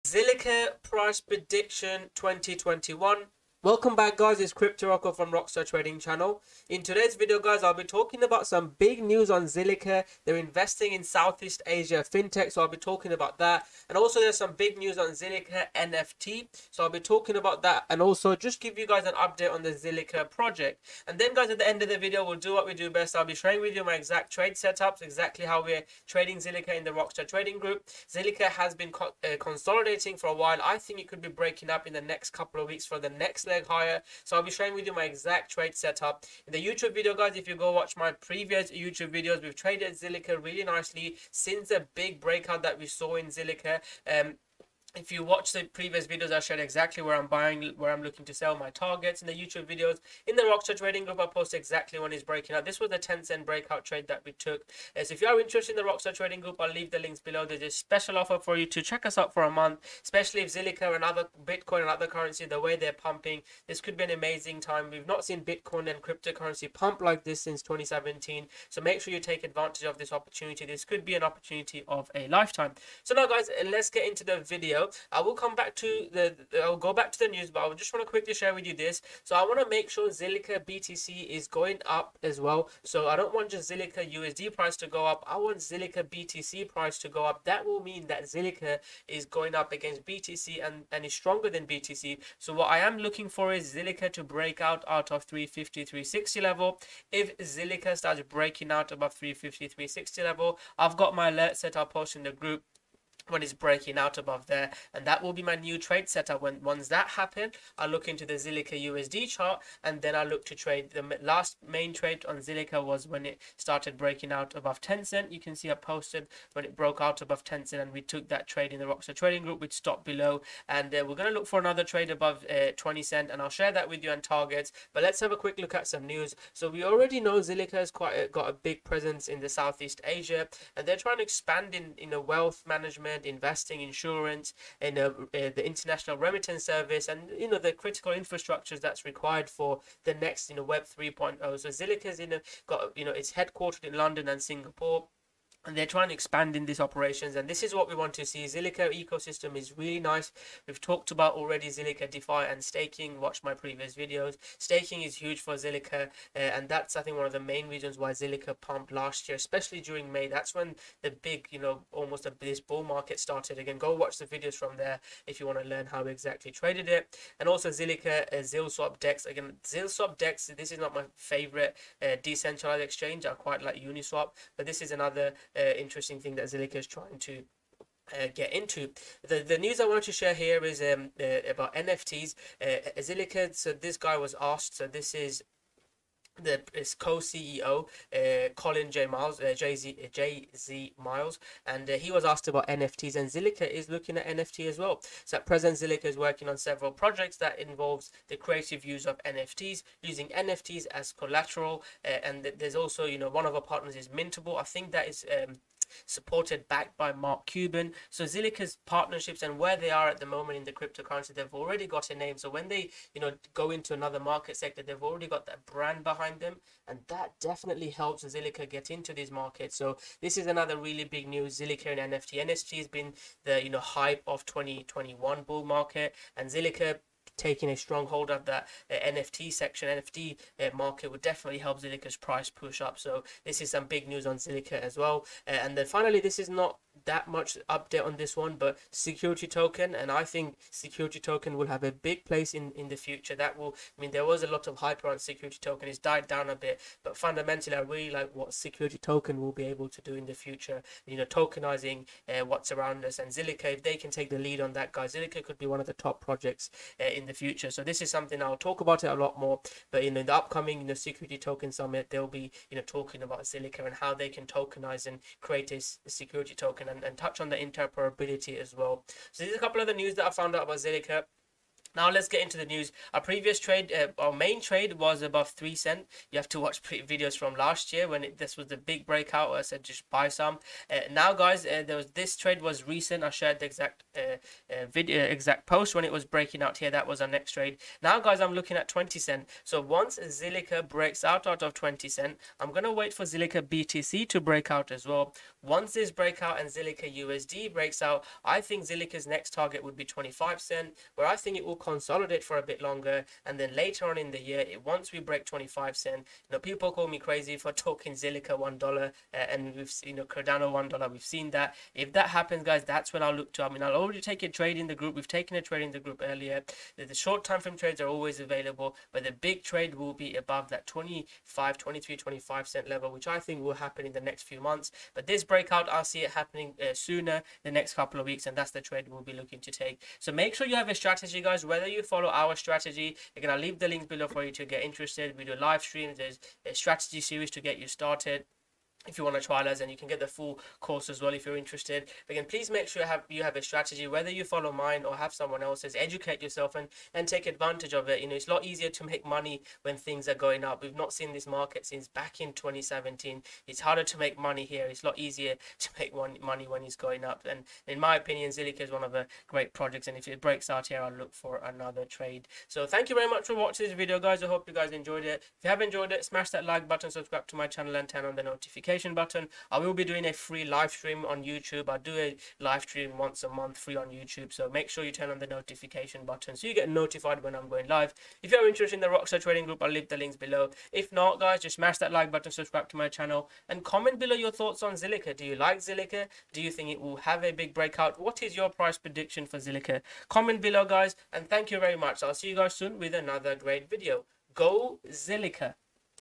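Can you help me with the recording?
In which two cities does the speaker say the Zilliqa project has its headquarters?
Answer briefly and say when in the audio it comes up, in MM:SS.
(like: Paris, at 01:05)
London and Singapore, at 02:23.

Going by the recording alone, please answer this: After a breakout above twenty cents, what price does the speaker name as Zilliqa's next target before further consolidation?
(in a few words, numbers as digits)
25 cents.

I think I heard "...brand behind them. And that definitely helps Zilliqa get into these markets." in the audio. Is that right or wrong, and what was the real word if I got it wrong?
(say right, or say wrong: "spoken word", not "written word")
right.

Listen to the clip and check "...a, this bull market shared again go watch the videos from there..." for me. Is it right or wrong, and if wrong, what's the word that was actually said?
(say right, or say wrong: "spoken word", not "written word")
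wrong: "started", not "shared".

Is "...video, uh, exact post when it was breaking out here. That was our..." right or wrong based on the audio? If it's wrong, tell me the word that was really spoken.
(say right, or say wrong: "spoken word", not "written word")
right.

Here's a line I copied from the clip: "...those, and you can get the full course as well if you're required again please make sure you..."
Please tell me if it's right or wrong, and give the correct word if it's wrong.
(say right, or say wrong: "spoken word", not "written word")
wrong: "interested", not "required".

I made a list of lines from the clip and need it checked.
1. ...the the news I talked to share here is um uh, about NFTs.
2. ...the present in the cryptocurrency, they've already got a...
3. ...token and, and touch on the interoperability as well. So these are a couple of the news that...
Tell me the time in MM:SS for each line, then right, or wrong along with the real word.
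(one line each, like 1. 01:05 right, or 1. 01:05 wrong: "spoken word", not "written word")
1. 02:59 wrong: "wanted", not "talked"
2. 03:30 wrong: "moment", not "present"
3. 04:26 right.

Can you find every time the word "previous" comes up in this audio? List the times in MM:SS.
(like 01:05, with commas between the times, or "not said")
00:38, 00:45, 02:33, 04:33.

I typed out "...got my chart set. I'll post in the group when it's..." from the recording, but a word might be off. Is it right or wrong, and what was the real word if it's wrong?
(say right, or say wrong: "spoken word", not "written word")
wrong: "alert", not "chart".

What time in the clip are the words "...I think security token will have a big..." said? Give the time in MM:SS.
04:00.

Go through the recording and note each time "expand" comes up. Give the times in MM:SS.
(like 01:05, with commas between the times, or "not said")
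02:11, 02:26.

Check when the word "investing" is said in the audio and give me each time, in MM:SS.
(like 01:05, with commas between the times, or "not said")
00:10, 02:13.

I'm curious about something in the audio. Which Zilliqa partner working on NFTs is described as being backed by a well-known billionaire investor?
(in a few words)
Mintable.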